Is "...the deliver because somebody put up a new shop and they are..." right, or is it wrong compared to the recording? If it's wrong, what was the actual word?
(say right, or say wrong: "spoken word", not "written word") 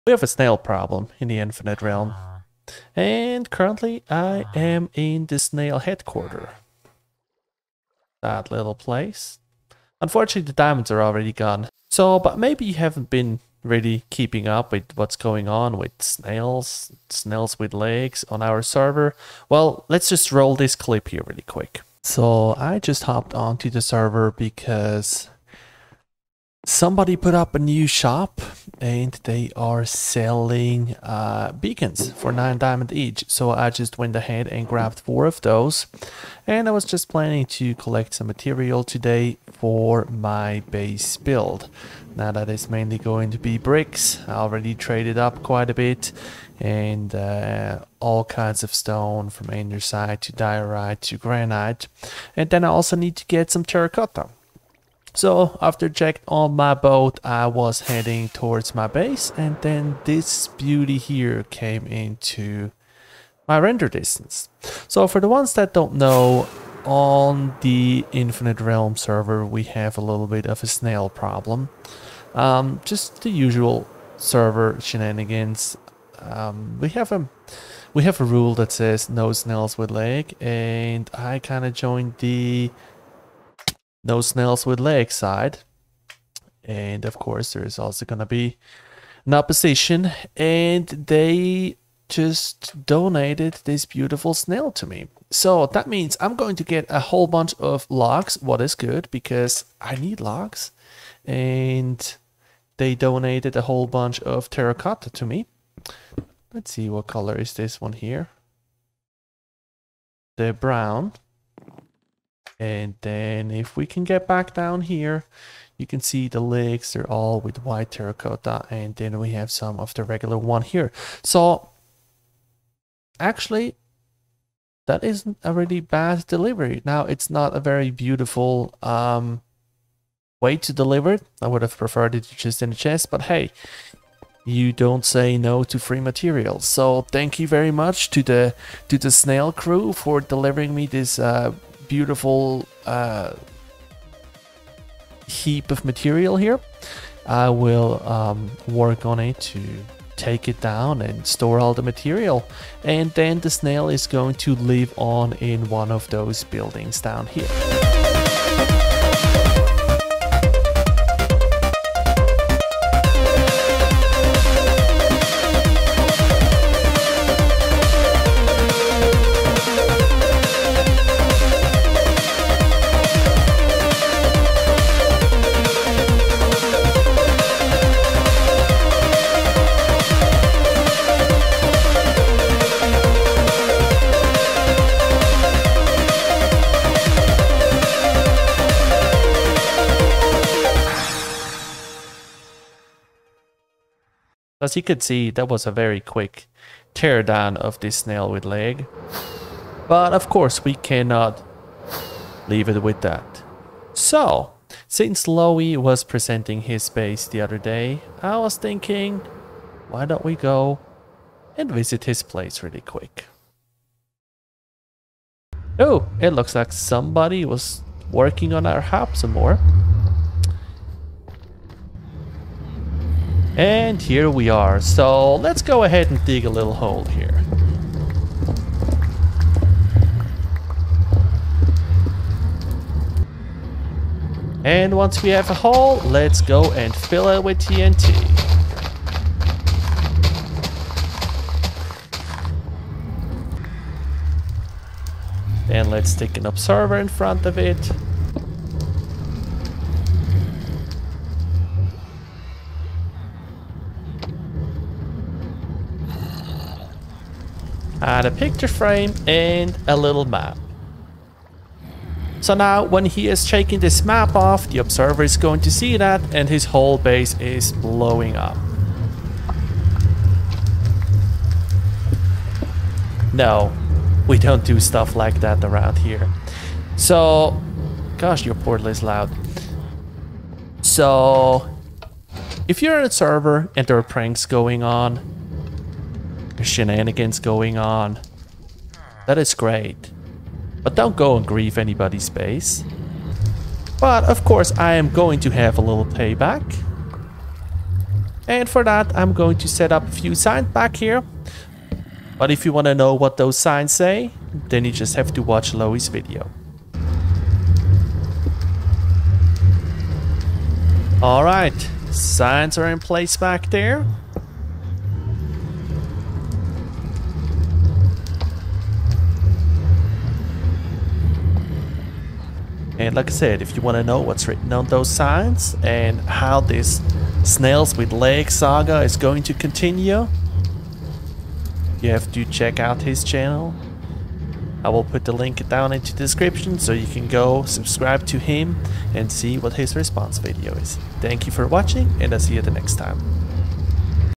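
wrong: "server", not "deliver".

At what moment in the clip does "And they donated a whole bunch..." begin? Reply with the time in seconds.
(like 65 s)
101 s.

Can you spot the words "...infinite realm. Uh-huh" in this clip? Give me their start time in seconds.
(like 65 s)
1 s.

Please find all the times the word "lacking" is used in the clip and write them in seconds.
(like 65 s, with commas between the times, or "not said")
not said.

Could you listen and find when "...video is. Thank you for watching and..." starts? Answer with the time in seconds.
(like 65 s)
340 s.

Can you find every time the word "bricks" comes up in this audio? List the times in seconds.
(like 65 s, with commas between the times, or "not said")
43 s.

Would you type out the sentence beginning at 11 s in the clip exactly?
So, but maybe you haven't been really keeping up with what's going on with snails, snails with legs on our server.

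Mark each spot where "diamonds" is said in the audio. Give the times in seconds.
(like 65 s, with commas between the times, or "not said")
10 s, 32 s.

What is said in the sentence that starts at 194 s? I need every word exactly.
As you could see, that was a very quick teardown of this snail with leg.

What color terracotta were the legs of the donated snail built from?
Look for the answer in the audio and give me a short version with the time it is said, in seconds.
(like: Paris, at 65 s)
White, at 117 s.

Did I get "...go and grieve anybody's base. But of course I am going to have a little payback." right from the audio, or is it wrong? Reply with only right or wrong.
right.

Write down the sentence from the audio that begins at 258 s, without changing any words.
add a picture frame and a little map.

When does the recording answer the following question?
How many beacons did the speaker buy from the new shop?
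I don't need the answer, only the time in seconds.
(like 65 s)
34 s.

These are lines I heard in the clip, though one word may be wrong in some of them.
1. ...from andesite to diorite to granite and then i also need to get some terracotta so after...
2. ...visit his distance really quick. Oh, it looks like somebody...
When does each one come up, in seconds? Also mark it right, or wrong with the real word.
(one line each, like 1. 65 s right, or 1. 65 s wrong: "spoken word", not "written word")
1. 49 s right
2. 211 s wrong: "place", not "distance".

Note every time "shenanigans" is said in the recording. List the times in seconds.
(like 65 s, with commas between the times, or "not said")
74 s, 286 s.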